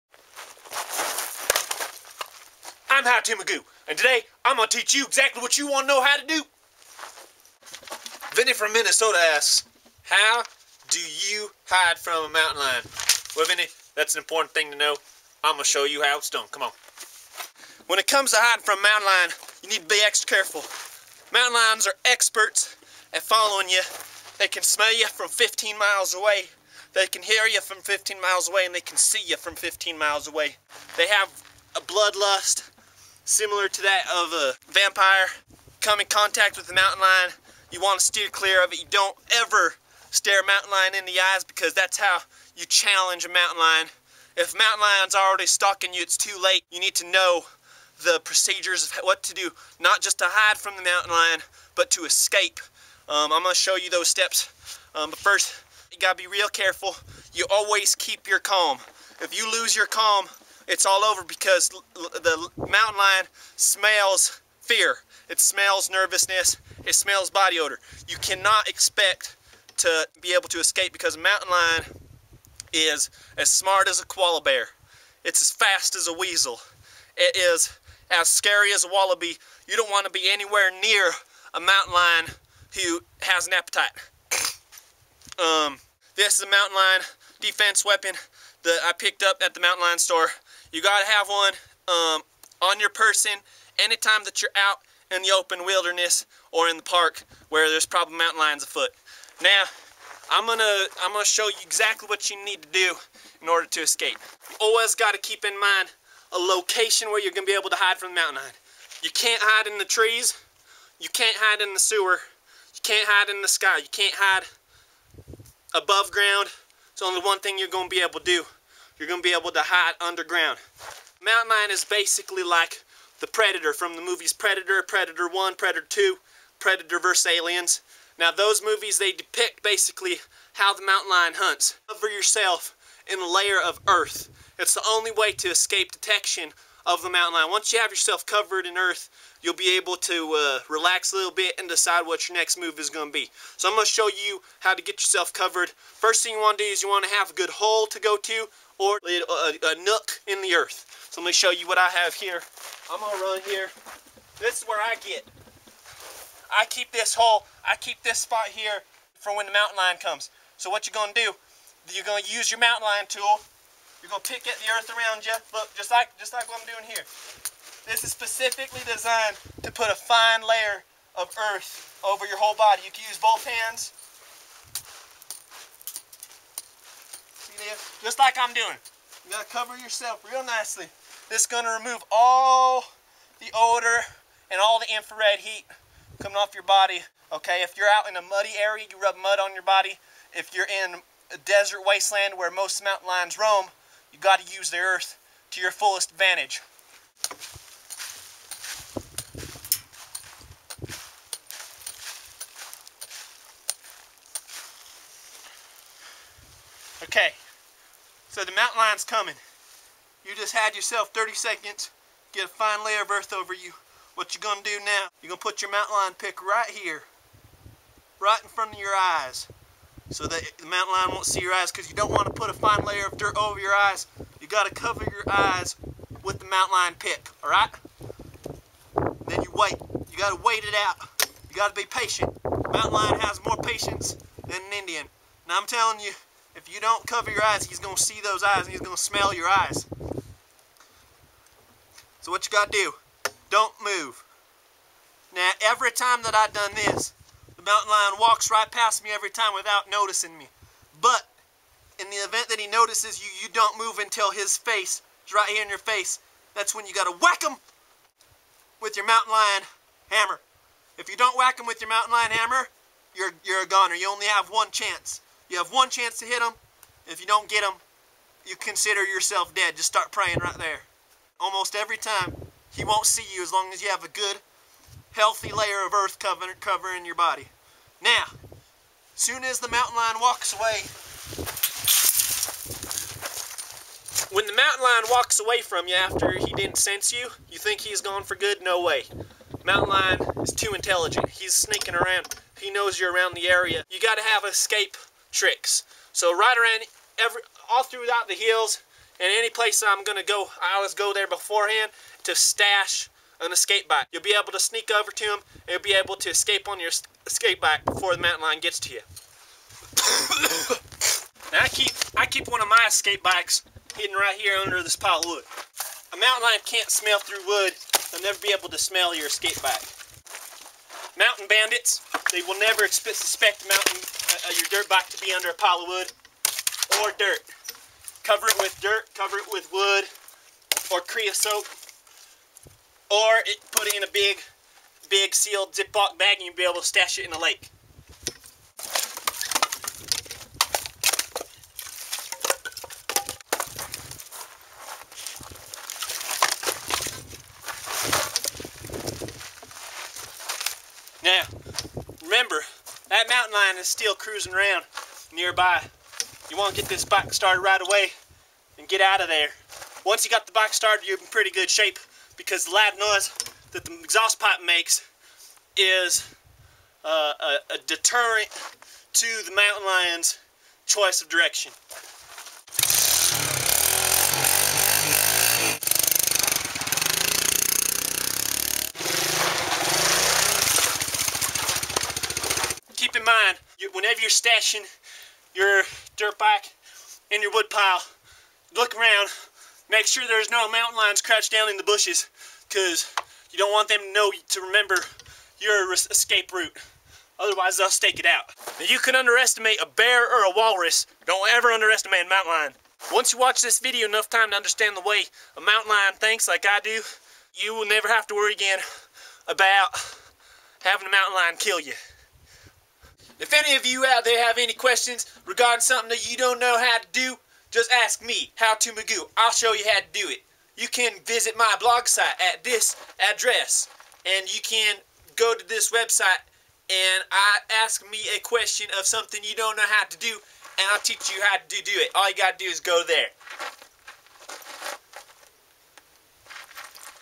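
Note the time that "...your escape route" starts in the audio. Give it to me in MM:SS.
06:35.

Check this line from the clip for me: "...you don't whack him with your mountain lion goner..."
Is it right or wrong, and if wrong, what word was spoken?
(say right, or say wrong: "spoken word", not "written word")
wrong: "hammer", not "goner".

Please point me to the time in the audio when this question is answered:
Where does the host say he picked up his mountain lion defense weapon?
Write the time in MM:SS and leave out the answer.
01:29.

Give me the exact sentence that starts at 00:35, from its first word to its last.
Come in contact with the mountain lion.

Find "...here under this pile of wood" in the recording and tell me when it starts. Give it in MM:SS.
05:14.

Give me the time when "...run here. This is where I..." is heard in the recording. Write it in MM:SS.
02:33.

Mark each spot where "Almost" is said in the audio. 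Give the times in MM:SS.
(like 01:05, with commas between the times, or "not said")
04:31.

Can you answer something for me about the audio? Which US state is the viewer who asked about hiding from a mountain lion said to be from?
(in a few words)
Minnesota.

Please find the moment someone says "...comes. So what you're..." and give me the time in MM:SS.
02:40.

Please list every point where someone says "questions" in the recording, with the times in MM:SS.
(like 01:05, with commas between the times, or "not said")
06:54, 07:08.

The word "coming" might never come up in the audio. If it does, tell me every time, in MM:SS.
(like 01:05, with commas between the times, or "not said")
03:06, 03:29.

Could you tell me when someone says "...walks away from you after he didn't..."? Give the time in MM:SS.
04:45.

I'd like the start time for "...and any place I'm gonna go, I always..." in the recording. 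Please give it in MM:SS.
04:59.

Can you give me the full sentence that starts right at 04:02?
So what you got to do, don't move.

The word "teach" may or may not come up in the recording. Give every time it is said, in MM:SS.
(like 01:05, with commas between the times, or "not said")
00:04, 07:10.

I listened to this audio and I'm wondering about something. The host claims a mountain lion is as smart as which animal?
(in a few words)
Koala bear.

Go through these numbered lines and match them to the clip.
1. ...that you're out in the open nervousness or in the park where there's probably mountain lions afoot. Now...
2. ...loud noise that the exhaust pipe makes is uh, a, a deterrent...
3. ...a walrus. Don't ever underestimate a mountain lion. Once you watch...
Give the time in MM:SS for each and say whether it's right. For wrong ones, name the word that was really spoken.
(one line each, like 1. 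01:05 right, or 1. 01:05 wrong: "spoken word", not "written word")
1. 01:34 wrong: "wilderness", not "nervousness"
2. 06:02 right
3. 06:40 right.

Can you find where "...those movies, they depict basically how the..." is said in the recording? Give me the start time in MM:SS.
02:08.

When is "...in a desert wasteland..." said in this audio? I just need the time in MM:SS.
03:10.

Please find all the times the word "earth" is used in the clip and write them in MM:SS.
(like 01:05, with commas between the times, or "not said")
02:13, 02:18, 02:30, 02:44, 02:51, 03:14, 03:33, 04:35.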